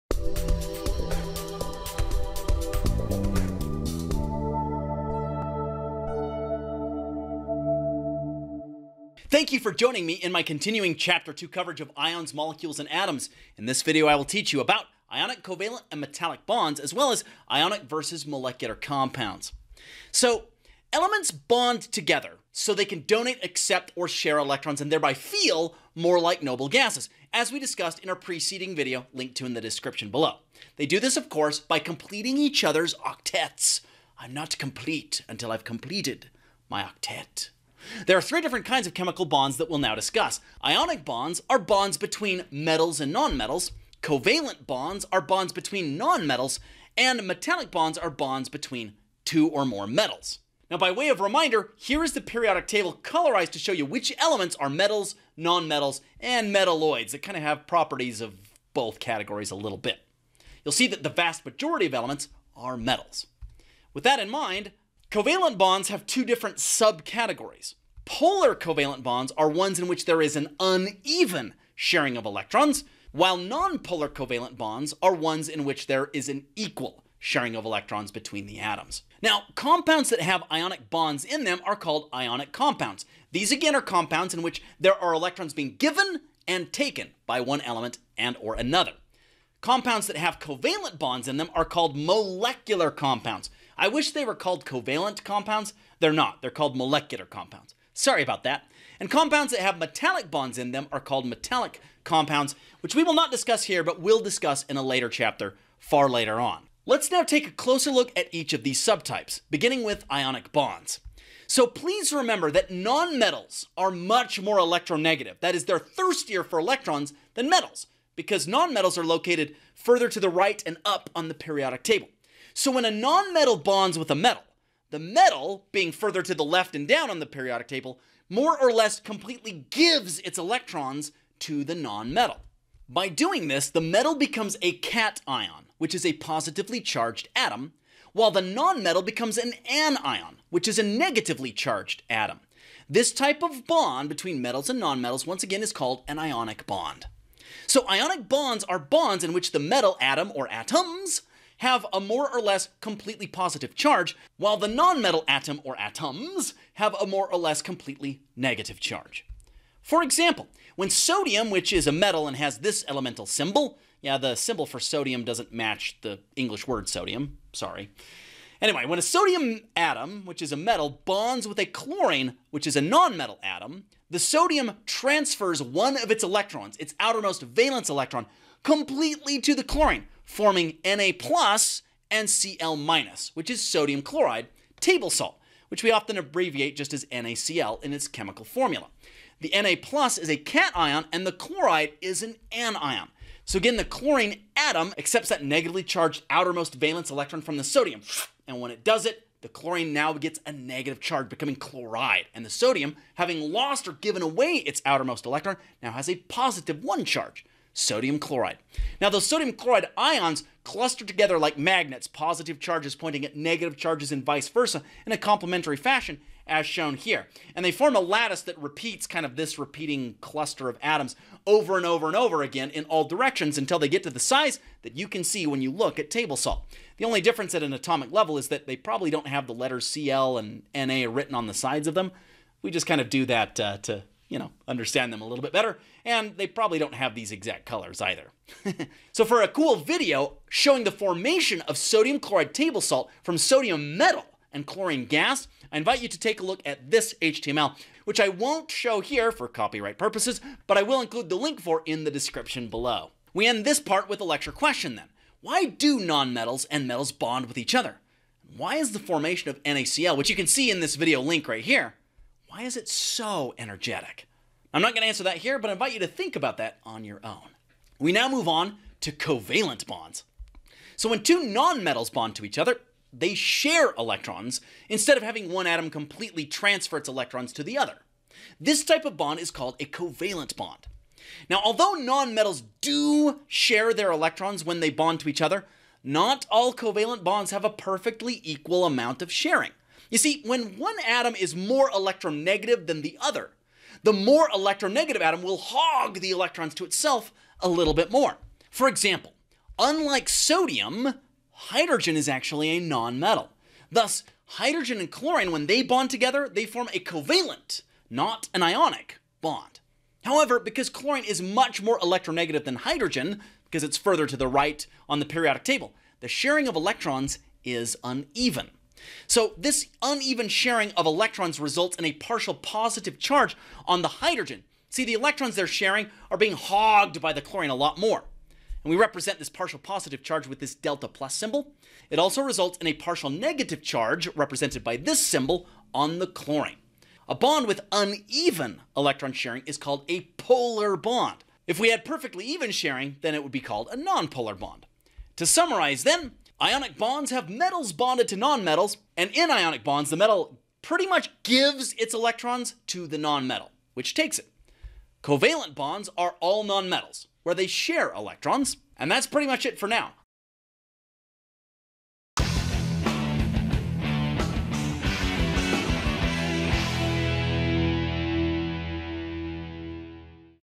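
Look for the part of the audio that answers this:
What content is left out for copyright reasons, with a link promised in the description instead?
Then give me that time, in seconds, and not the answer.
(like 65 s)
247 s.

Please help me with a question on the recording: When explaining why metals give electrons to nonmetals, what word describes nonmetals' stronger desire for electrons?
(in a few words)
thirstier.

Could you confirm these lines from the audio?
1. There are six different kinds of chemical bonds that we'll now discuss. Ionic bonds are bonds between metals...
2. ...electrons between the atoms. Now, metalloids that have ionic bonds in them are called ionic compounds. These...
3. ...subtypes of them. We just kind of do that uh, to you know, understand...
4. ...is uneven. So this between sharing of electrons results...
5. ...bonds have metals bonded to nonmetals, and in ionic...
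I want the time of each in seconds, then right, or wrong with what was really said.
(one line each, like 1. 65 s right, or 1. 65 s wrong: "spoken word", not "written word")
1. 38 s wrong: "three", not "six"
2. 77 s wrong: "compounds", not "metalloids"
3. 231 s wrong: "sides", not "subtypes"
4. 317 s wrong: "uneven", not "between"
5. 346 s right.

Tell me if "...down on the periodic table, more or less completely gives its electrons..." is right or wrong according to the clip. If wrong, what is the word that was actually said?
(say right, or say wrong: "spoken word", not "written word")
right.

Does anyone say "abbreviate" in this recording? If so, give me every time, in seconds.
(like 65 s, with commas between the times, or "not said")
186 s.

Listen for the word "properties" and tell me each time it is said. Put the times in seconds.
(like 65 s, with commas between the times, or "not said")
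57 s.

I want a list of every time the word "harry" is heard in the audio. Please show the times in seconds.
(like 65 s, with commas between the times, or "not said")
not said.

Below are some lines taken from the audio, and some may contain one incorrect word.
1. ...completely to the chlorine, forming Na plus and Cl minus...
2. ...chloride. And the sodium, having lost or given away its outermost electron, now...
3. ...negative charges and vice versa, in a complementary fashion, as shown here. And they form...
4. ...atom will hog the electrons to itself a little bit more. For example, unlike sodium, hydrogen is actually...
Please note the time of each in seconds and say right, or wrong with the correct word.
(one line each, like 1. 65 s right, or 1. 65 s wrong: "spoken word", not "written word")
1. 178 s right
2. 201 s right
3. 213 s right
4. 295 s right.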